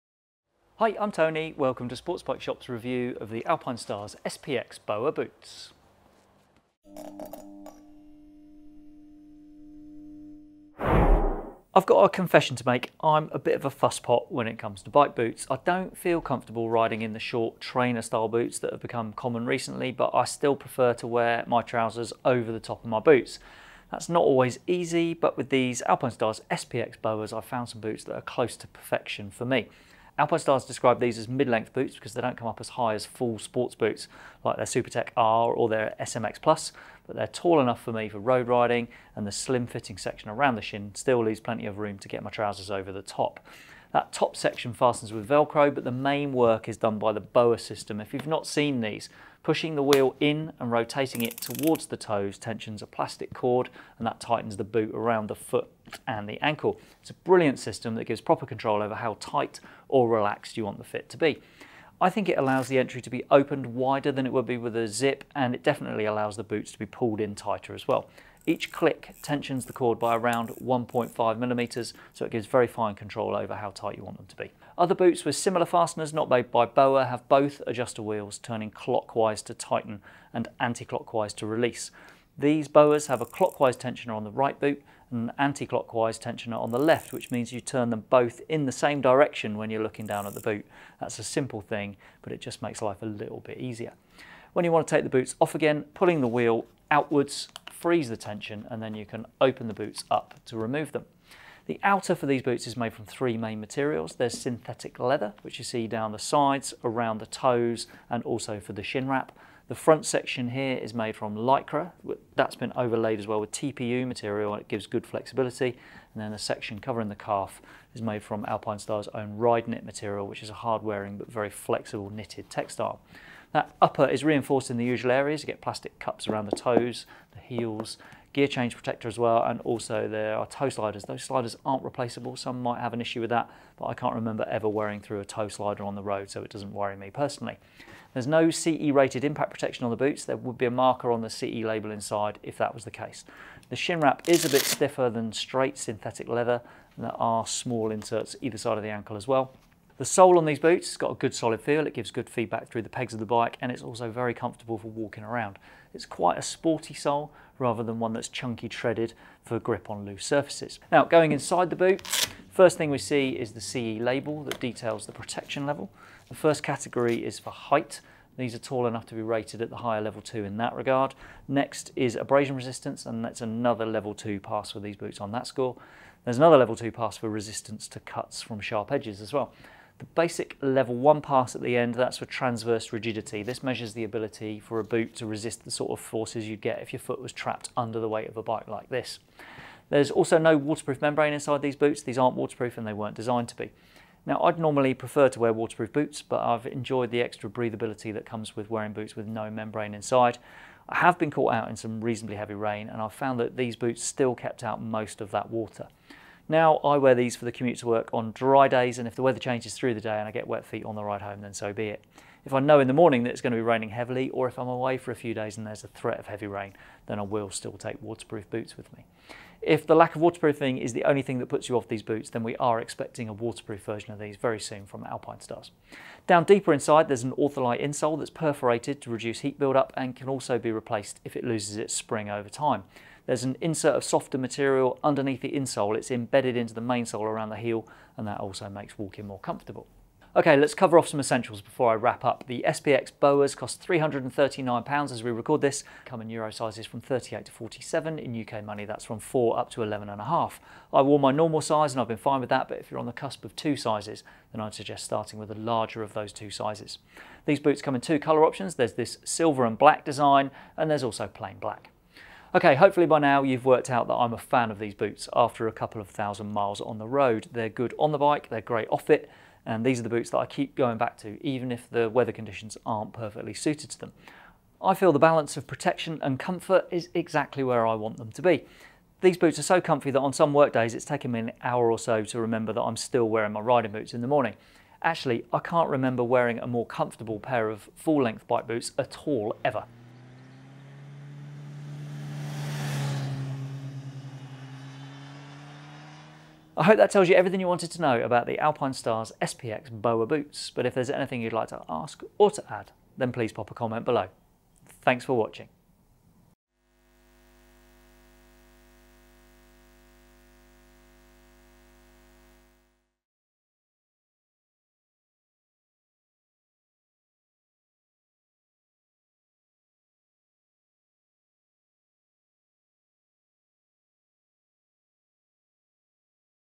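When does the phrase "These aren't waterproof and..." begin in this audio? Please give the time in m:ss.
3:12.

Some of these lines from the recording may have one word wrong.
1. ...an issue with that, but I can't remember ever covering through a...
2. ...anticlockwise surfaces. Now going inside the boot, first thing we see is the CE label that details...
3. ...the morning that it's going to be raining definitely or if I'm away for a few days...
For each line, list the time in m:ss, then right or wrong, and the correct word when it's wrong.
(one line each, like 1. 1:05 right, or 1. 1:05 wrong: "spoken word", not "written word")
1. 2:12 wrong: "wearing", not "covering"
2. 2:40 wrong: "loose", not "anticlockwise"
3. 3:32 wrong: "heavily", not "definitely".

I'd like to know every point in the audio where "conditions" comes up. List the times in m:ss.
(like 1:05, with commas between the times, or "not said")
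4:32.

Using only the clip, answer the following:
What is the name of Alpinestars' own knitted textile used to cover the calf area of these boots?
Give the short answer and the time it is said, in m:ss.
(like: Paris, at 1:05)
Ride Knit, at 1:59.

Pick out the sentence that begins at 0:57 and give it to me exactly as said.
It's a brilliant system that gives proper control over how tight or relaxed you want the fit to be.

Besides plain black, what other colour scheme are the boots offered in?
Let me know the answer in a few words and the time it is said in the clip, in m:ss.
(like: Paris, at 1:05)
silver and black, at 4:19.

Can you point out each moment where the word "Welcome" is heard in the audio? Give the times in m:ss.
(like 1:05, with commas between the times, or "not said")
0:01.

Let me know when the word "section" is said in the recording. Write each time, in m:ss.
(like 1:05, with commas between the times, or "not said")
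0:39, 0:44, 1:50, 1:56.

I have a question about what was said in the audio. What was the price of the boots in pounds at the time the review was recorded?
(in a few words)
£339.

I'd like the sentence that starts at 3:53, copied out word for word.
There's an insert of softer material underneath the insole.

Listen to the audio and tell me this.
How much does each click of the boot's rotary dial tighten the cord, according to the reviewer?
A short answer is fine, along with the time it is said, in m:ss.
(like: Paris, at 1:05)
1.5 millimeters, at 1:10.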